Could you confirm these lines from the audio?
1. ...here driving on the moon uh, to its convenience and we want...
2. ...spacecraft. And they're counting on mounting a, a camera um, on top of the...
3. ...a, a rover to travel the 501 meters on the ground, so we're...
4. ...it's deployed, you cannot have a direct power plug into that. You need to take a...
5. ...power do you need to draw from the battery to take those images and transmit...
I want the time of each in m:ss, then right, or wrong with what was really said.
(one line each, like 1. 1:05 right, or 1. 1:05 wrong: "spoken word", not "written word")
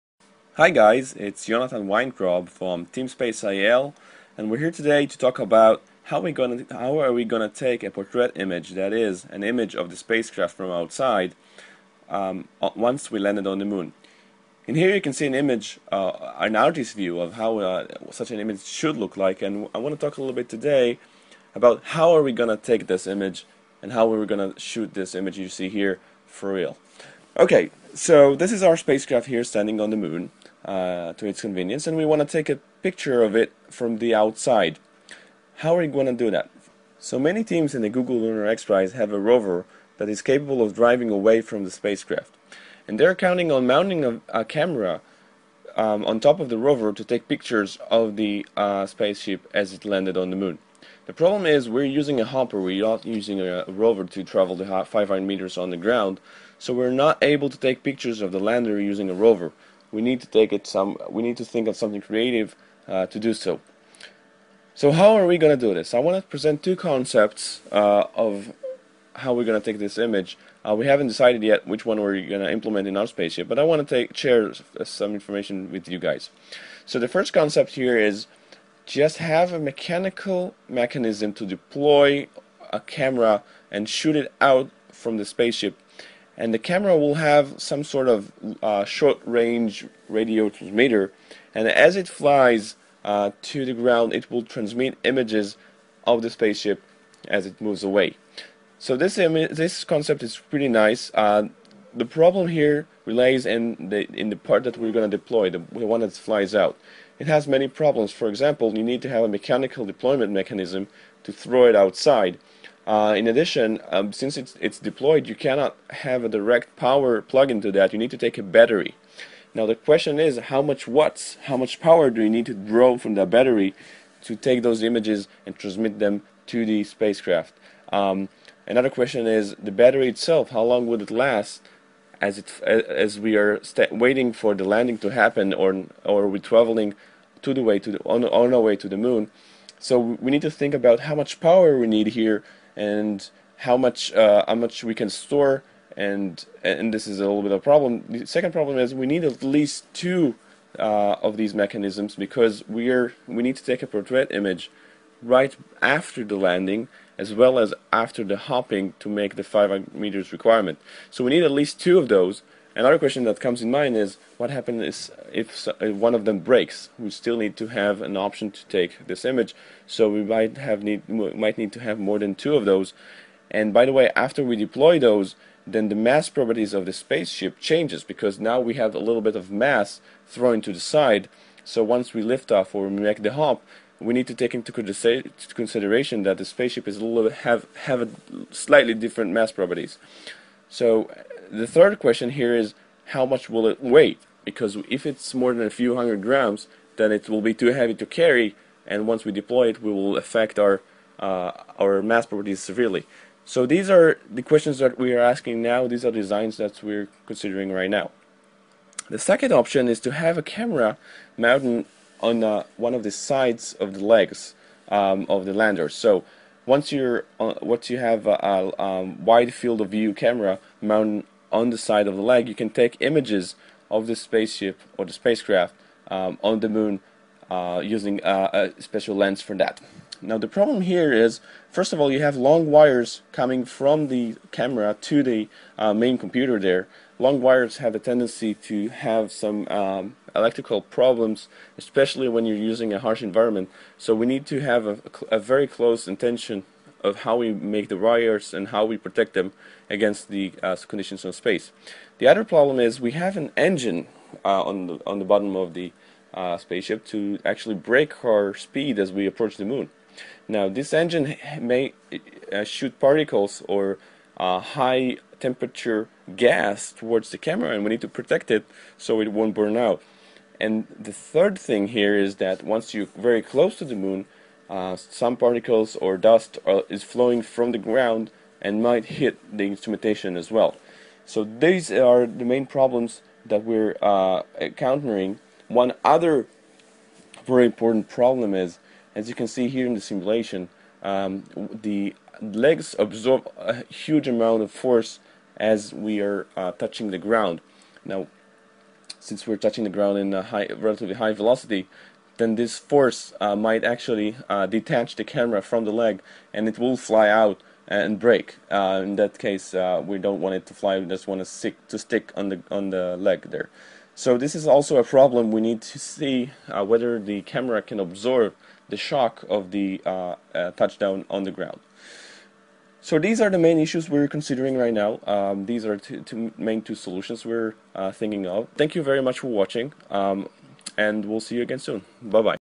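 1. 0:29 wrong: "standing", not "driving"
2. 0:41 right
3. 0:53 wrong: "500", not "501"
4. 1:54 right
5. 2:01 right.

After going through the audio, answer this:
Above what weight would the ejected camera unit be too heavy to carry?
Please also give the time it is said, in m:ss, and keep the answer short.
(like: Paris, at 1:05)
A few hundred grams, at 3:15.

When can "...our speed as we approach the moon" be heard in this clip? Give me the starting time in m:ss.
4:18.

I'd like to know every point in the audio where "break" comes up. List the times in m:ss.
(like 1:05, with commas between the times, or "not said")
2:46, 4:17, 5:08.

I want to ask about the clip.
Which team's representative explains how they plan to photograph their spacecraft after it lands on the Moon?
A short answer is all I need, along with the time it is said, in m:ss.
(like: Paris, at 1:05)
SpaceIL, at 0:03.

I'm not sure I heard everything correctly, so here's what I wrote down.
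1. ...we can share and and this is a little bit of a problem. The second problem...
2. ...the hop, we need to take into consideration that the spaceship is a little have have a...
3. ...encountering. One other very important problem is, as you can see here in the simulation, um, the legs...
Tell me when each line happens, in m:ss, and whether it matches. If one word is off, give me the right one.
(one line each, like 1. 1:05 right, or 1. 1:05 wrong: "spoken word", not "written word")
1. 2:24 wrong: "store", not "share"
2. 3:03 right
3. 4:44 right.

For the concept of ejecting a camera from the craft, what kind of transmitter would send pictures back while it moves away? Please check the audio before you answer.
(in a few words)
Short-range radio transmitter.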